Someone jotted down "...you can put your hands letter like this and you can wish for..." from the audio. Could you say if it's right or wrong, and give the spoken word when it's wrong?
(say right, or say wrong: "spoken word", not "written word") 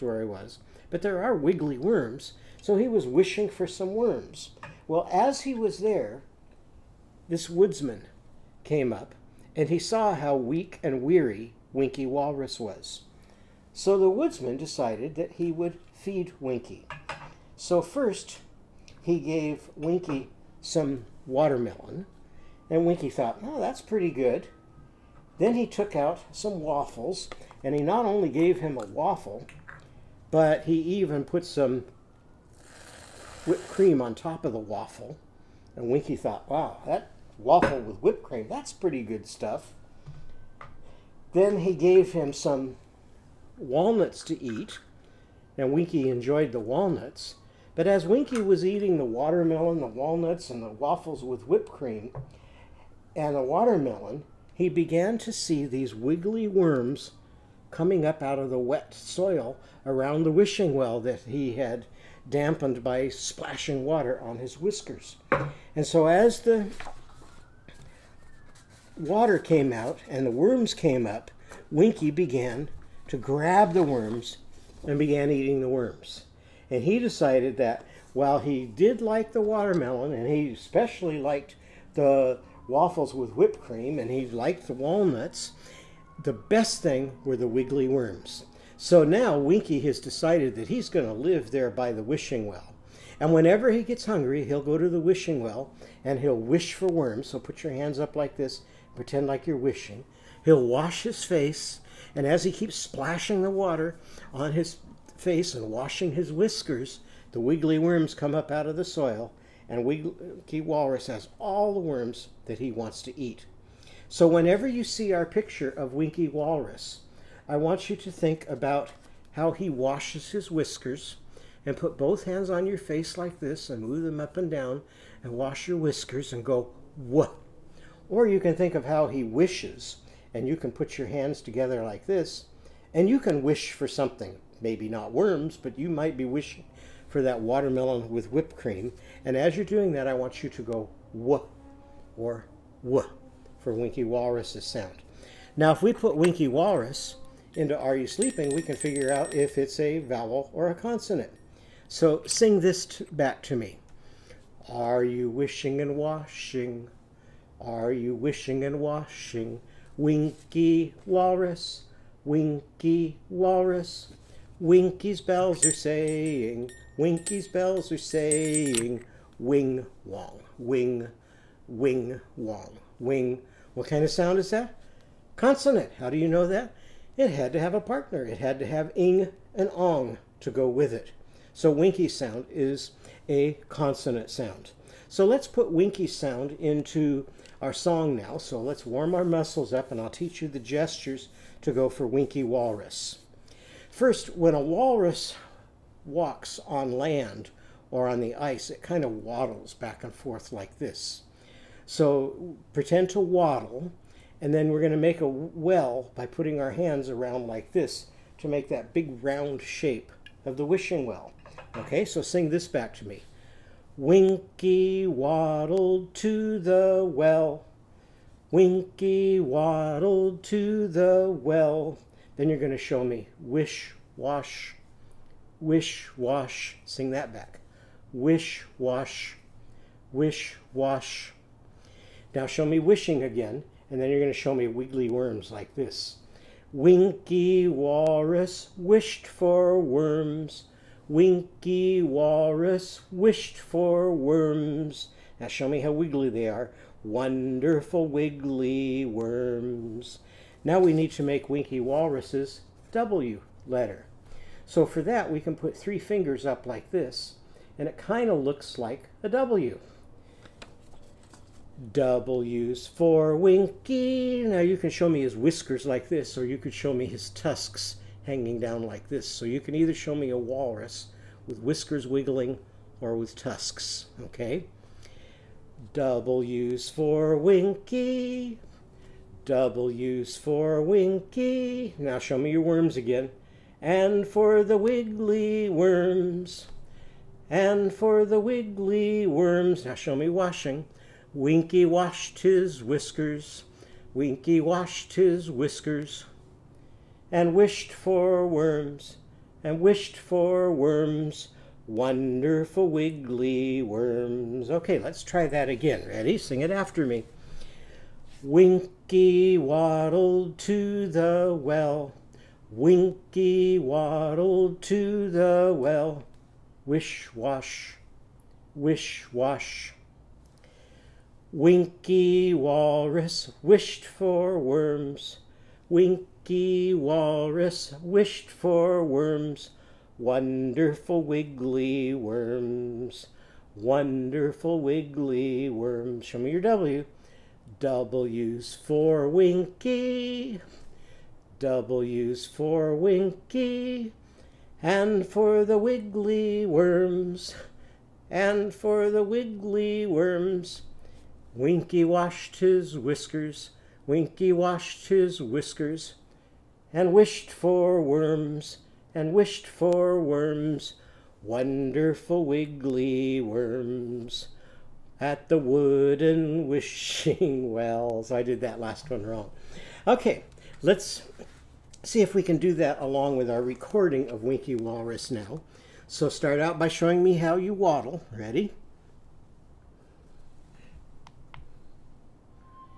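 wrong: "together", not "letter".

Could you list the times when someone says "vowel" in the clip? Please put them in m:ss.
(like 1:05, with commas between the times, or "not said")
2:29.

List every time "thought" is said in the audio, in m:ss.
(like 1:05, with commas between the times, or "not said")
0:23, 0:36.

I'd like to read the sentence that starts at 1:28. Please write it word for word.
So now Winkie has decided that he's going to live there by the wishing well.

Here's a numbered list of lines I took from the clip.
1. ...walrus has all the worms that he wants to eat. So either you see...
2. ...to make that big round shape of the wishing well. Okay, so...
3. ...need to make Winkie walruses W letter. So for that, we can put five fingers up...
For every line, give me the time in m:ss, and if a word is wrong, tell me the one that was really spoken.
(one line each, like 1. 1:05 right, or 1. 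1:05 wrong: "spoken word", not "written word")
1. 1:50 wrong: "whenever", not "either"
2. 3:28 right
3. 4:10 wrong: "three", not "five".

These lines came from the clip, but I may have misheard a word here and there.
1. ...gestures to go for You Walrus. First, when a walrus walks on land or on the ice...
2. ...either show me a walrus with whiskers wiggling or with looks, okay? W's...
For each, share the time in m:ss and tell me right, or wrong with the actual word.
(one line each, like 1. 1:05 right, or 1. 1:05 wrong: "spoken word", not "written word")
1. 3:10 wrong: "Winkie", not "You"
2. 4:29 wrong: "tusks", not "looks".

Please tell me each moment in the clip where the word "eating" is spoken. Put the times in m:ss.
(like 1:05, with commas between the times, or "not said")
0:48, 1:15.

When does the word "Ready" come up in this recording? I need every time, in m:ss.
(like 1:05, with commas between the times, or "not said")
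5:06, 6:18.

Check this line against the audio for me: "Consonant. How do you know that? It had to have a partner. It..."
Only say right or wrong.
right.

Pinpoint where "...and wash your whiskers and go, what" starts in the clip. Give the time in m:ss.
2:05.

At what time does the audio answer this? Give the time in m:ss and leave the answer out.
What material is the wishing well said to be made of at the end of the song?
6:05.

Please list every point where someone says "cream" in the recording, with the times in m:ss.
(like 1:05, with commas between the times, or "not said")
0:33, 0:38, 0:51, 1:23, 2:18.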